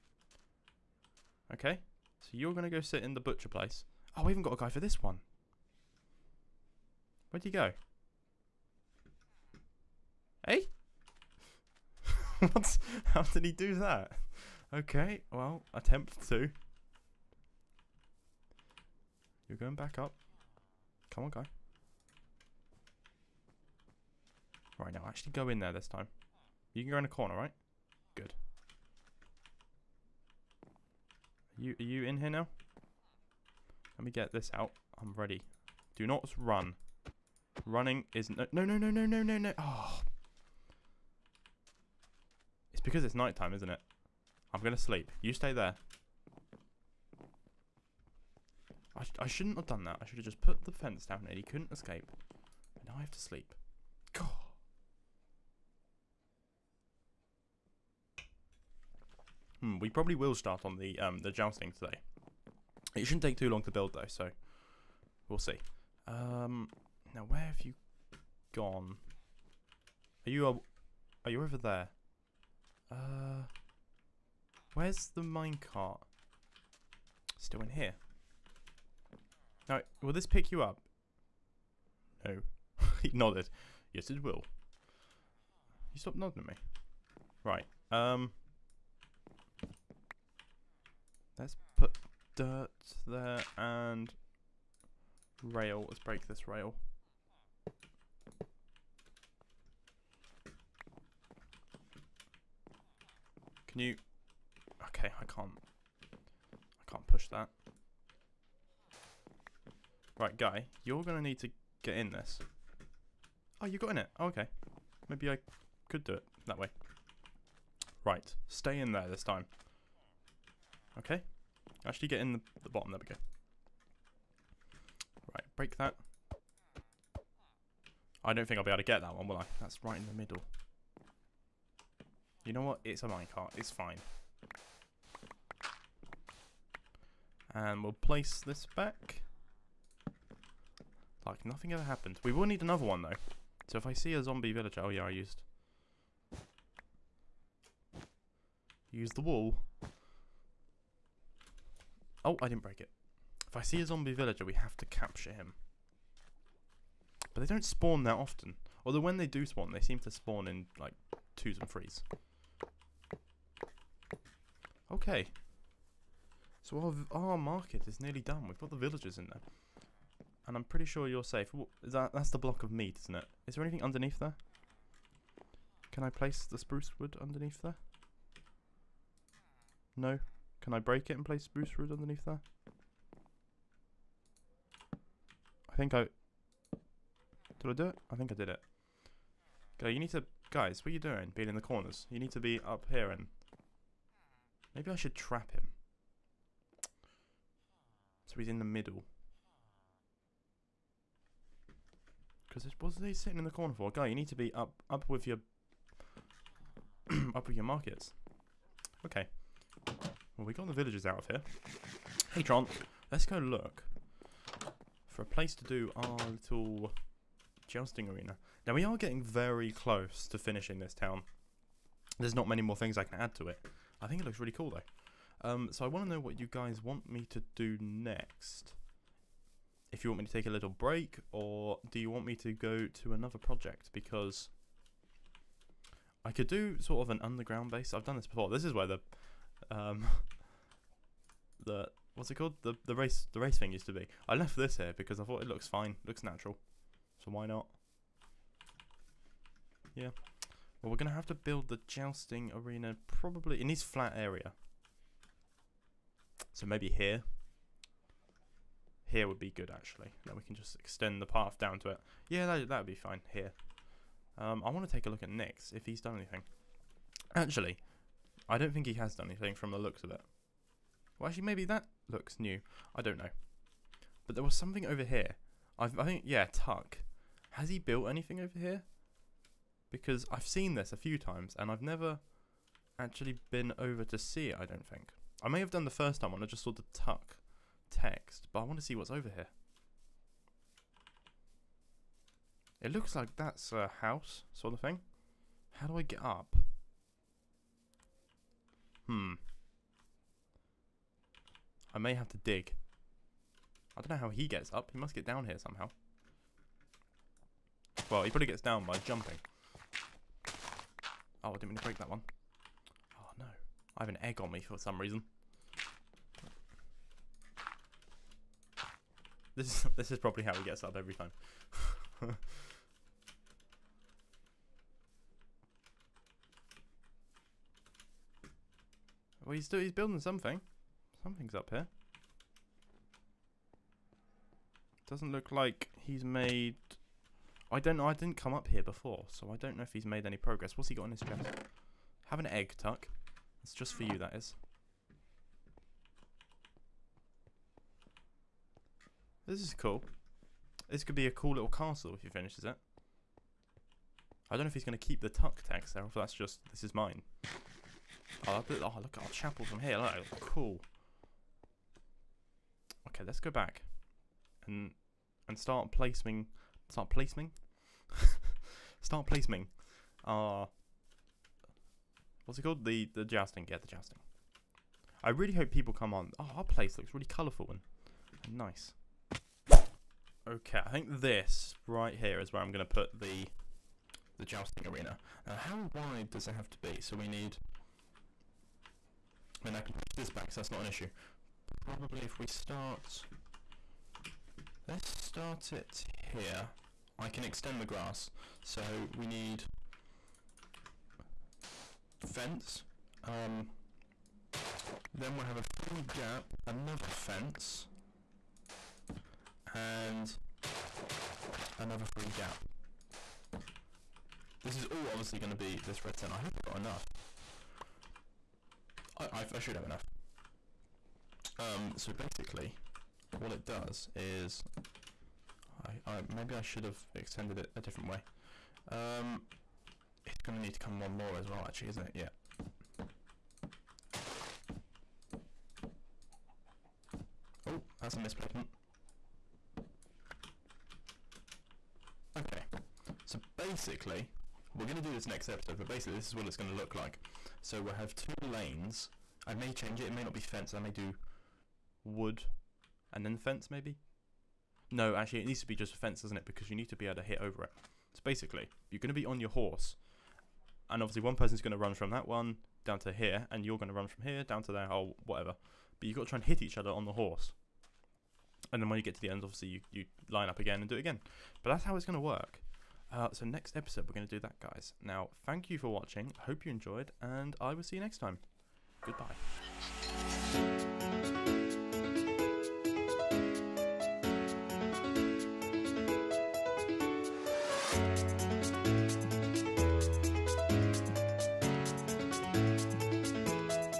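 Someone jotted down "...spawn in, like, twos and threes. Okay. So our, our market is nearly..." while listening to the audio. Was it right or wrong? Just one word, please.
right.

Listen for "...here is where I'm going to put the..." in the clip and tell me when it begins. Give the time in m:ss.
6:22.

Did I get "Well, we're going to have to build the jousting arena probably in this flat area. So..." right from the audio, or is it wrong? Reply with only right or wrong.
right.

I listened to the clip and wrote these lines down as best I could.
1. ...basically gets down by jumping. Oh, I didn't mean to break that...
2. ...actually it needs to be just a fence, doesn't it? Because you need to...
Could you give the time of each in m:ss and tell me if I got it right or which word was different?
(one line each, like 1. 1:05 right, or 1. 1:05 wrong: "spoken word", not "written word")
1. 5:08 wrong: "probably", not "basically"
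2. 7:35 right.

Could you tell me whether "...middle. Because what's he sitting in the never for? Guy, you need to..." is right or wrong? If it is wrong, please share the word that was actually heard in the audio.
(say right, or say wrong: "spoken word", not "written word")
wrong: "corner", not "never".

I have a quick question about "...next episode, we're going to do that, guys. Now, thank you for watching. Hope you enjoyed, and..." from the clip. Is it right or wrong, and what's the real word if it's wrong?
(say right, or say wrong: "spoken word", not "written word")
right.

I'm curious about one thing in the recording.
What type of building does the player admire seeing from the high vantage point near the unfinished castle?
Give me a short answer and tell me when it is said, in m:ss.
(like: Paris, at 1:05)
chapel, at 5:59.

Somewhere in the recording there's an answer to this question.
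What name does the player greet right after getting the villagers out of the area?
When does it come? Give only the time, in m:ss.
3:32.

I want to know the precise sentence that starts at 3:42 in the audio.
There's not many more things I can add to it.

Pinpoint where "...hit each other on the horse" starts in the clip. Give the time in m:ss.
7:46.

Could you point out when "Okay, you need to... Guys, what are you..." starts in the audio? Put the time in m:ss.
3:09.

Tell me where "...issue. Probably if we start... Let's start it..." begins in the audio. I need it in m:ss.
6:30.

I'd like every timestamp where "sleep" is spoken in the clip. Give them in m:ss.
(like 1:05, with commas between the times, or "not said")
0:44, 0:53.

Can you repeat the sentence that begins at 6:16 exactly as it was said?
Oh, our place looks really colourful and nice.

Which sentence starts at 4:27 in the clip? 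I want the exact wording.
Actually, I don't think he has done anything from the looks of it.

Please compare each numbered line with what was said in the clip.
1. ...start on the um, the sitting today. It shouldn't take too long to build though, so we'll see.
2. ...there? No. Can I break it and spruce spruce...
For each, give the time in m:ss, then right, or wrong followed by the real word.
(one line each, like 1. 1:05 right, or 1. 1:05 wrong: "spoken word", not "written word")
1. 1:00 wrong: "jousting", not "sitting"
2. 2:57 wrong: "place", not "spruce".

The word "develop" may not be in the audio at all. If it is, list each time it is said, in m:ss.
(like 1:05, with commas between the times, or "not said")
not said.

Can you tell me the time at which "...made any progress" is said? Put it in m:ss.
5:40.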